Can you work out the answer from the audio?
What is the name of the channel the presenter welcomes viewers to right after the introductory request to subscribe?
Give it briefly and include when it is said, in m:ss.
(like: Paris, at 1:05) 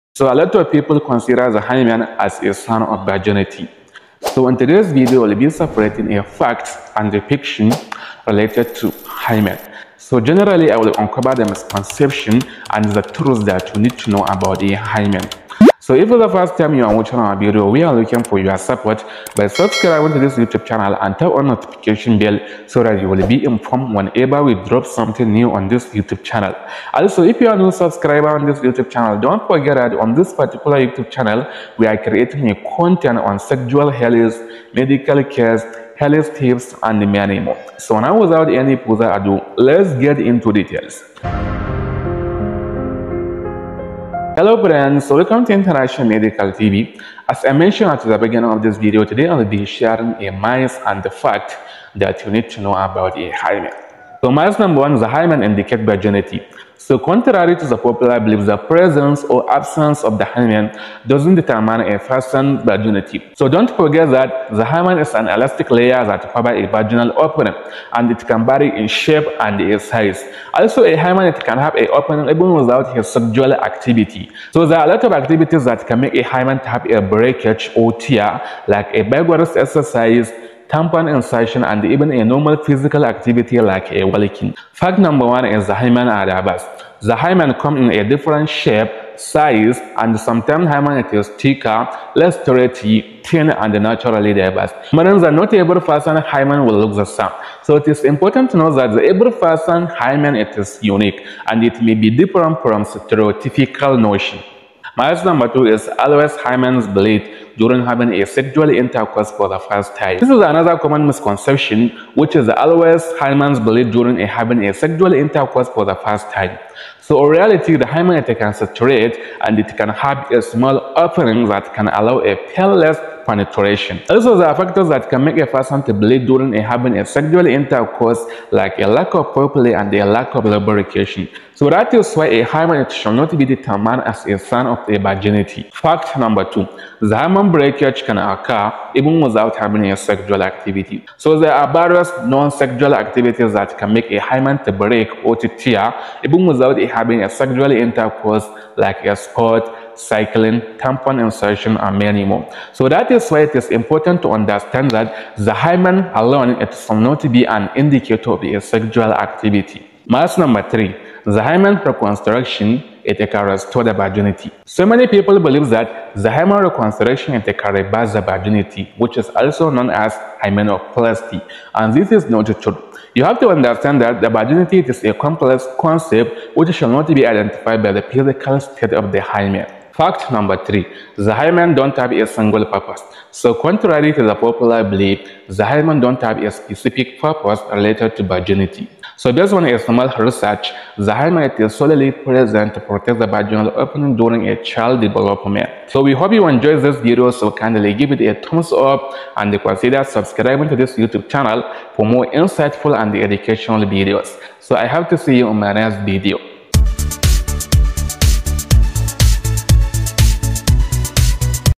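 International Medical TV, at 0:45.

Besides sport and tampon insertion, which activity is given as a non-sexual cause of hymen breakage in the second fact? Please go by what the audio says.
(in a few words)
Cycling.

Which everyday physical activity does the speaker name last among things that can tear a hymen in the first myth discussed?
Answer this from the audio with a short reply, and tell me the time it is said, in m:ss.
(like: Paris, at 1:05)
Walking, at 1:24.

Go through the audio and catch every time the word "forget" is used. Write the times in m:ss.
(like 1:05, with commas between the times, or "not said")
0:29, 1:03.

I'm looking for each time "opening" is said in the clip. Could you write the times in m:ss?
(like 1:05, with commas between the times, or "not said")
1:07, 1:11, 2:00, 3:13.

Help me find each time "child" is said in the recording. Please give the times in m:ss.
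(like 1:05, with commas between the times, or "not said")
3:14.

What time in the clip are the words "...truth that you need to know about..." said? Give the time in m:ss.
0:13.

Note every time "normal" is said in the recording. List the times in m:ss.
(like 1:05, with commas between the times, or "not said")
1:22.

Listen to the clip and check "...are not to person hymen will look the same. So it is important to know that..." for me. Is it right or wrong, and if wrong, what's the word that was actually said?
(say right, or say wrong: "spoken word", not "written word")
right.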